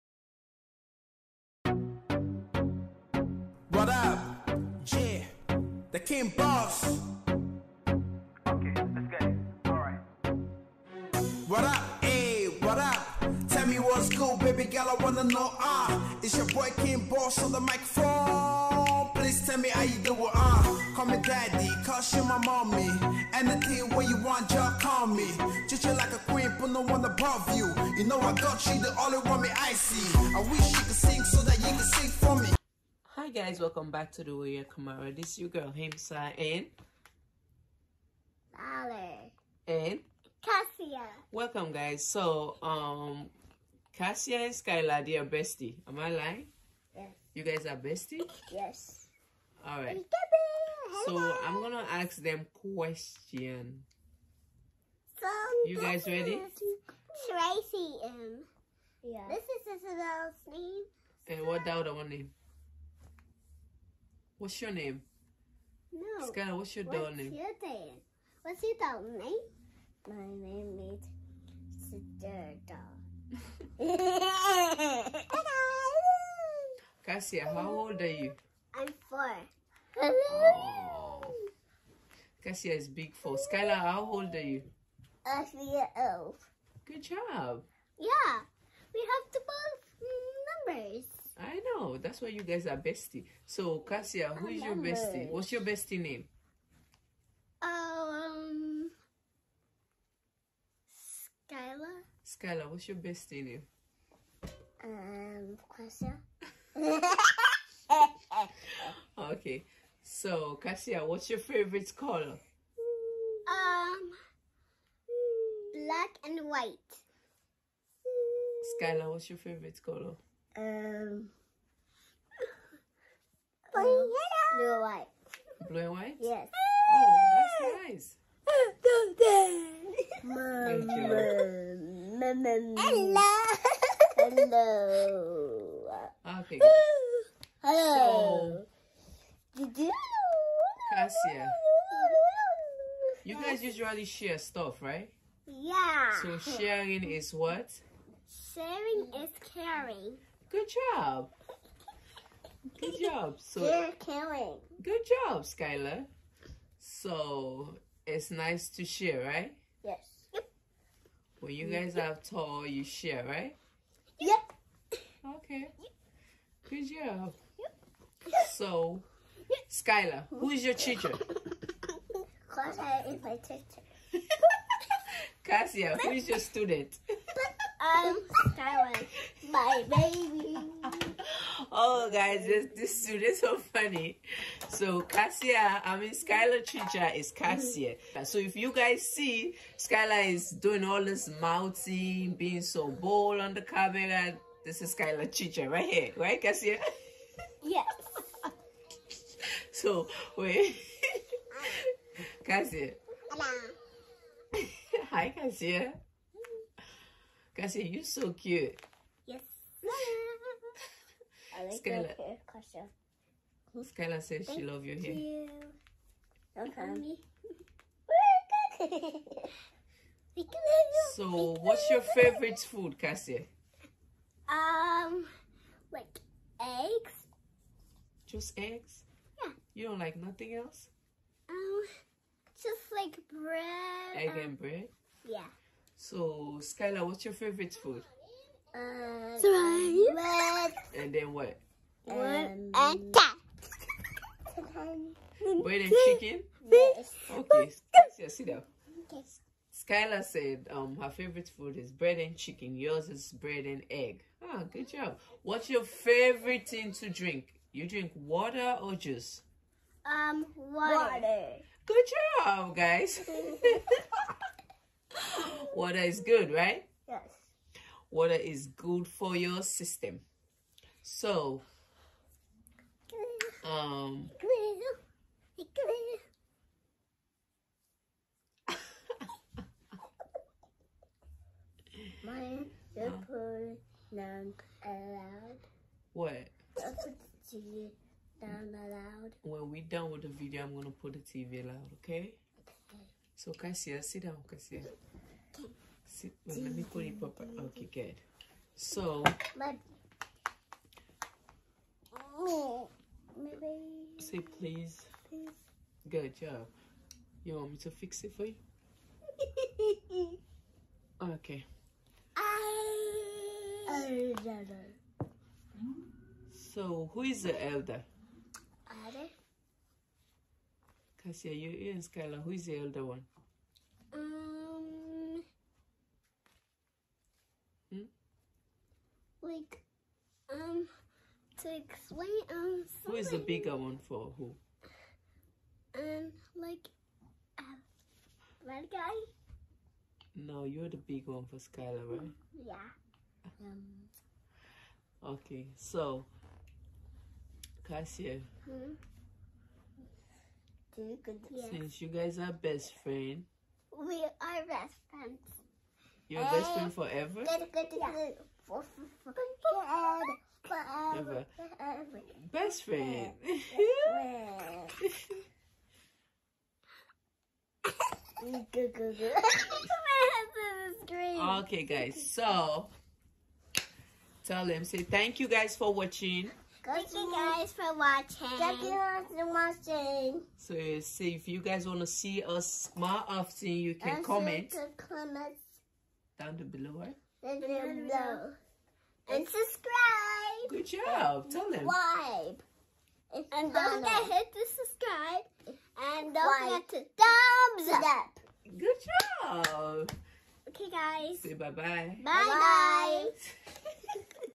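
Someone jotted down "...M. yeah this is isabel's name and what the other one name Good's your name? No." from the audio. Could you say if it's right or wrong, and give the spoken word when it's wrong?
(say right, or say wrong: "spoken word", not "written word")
wrong: "What", not "Good".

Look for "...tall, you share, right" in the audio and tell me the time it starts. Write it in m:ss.
2:42.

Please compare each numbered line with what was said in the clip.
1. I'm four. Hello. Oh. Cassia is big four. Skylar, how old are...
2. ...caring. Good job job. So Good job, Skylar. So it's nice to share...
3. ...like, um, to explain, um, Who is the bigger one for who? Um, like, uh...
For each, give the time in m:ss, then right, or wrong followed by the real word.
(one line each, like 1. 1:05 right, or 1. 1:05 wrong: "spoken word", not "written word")
1. 1:18 right
2. 2:29 right
3. 5:29 right.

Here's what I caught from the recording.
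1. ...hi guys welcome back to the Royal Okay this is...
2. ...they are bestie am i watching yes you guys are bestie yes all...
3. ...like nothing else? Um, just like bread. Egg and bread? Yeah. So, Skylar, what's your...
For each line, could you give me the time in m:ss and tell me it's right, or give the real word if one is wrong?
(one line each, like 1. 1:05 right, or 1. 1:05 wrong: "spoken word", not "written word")
1. 0:33 wrong: "Kamara", not "Okay"
2. 0:45 wrong: "lying", not "watching"
3. 3:49 right.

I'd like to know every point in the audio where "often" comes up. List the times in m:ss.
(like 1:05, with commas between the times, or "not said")
6:23.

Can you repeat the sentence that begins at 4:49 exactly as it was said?
When we're done with the video, I'm going to put the TV loud.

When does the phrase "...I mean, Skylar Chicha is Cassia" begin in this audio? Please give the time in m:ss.
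3:05.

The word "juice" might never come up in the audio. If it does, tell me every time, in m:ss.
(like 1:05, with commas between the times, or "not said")
4:18.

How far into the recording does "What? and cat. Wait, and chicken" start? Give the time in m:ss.
4:02.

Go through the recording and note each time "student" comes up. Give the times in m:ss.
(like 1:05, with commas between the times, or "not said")
2:56.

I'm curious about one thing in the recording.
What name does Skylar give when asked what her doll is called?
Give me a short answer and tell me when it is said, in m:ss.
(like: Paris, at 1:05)
Sister Doll, at 1:11.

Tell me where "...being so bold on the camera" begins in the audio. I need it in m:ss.
3:12.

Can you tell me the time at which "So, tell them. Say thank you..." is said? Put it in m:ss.
6:12.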